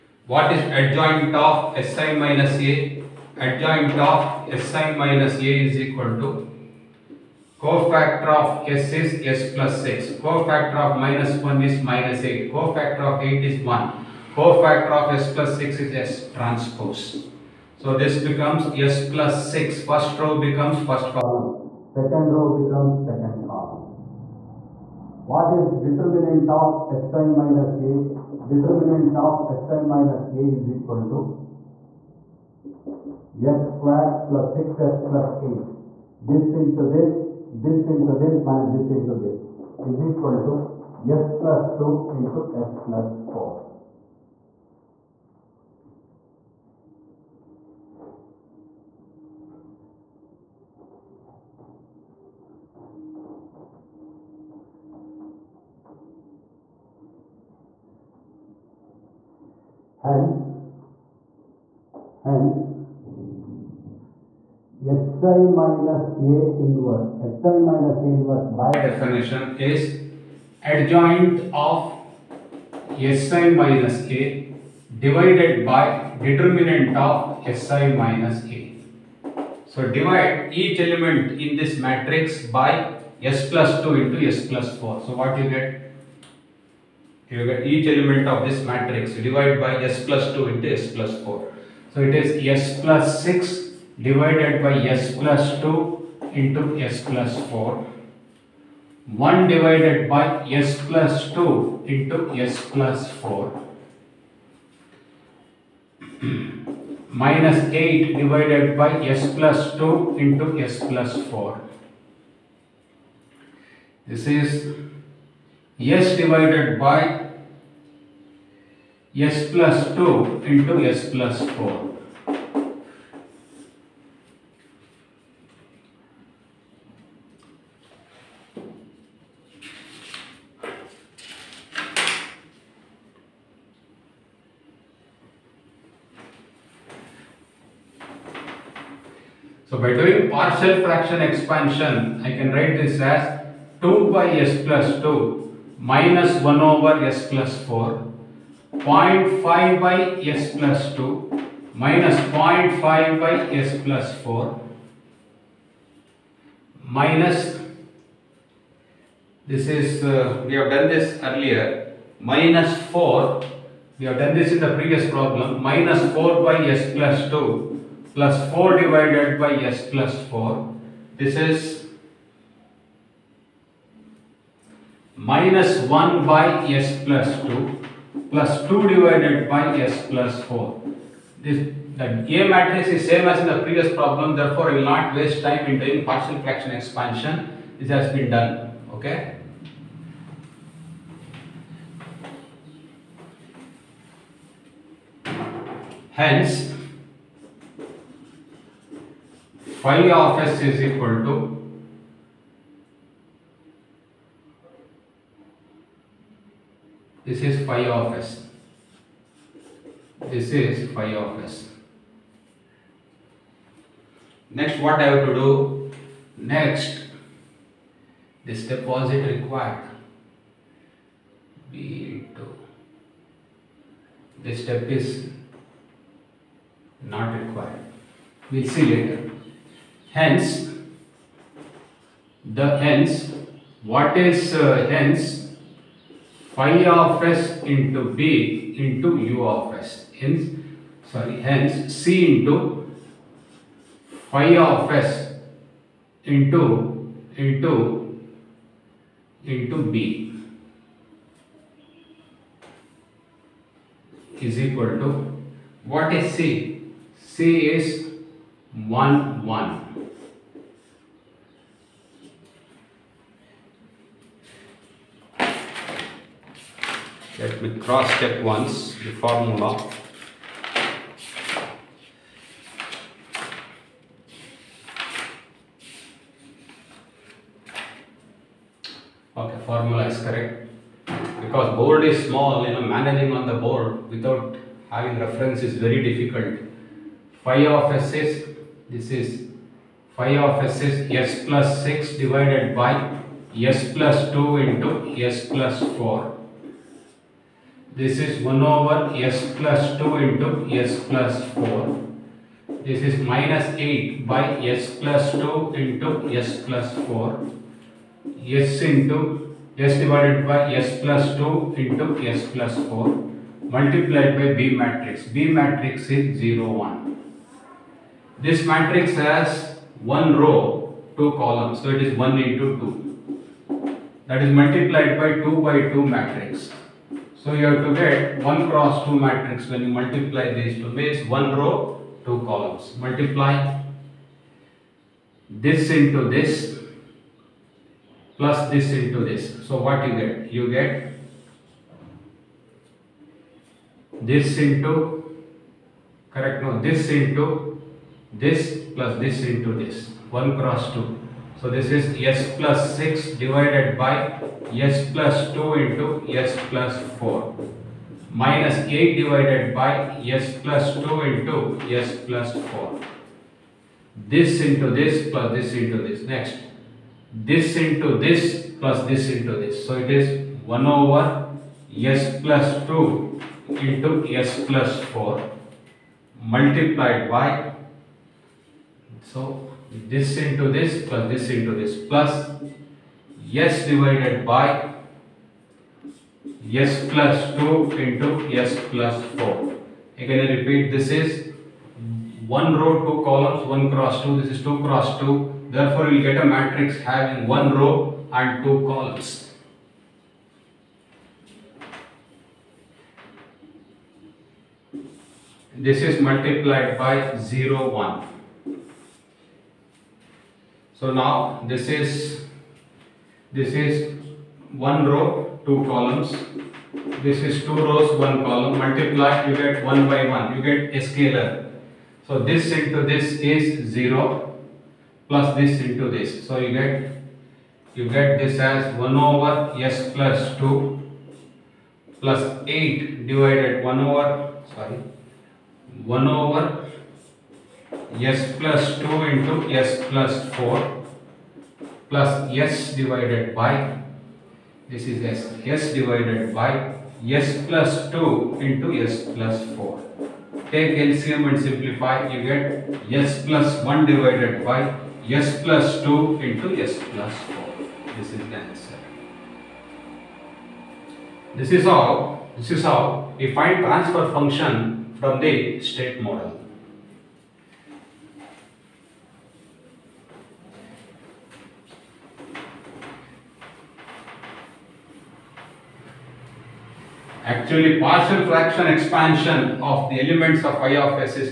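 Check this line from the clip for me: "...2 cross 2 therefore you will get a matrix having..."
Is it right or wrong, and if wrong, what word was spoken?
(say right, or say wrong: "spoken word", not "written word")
right.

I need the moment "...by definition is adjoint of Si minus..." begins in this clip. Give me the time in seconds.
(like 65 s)
68 s.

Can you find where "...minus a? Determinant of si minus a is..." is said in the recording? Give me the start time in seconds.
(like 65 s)
27 s.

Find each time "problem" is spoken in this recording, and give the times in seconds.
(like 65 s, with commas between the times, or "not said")
165 s, 183 s.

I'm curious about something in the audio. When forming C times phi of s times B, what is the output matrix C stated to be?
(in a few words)
1 1.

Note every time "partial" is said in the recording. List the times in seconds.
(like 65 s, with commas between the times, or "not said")
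140 s, 186 s, 477 s.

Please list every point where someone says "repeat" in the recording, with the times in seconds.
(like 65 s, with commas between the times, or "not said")
390 s.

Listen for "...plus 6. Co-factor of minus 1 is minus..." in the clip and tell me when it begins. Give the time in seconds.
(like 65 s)
9 s.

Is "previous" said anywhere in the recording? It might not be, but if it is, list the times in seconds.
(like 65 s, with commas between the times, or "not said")
164 s, 183 s.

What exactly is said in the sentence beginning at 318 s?
This matrix has one row, two columns.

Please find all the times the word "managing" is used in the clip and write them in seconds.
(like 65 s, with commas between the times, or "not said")
282 s.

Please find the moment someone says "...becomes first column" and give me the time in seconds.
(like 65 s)
20 s.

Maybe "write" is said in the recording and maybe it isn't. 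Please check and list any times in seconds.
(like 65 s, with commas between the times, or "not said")
142 s.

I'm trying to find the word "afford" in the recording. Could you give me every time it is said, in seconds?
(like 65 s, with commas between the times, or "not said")
not said.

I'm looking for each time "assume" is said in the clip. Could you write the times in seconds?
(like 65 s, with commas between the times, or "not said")
not said.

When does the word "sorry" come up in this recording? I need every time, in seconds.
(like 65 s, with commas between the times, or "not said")
241 s, 434 s.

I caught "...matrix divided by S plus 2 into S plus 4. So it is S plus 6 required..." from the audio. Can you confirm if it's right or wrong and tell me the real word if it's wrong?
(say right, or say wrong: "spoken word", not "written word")
wrong: "divided", not "required".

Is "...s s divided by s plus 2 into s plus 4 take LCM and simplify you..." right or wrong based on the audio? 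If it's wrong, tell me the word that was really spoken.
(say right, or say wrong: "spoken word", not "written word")
right.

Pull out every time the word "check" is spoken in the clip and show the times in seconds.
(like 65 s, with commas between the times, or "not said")
268 s.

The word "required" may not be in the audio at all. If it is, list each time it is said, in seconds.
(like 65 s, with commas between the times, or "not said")
219 s, 227 s.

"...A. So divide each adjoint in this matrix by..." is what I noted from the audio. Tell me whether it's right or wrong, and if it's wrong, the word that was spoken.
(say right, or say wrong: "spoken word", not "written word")
wrong: "element", not "adjoint".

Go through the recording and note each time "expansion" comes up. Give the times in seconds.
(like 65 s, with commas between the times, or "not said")
141 s, 186 s, 478 s.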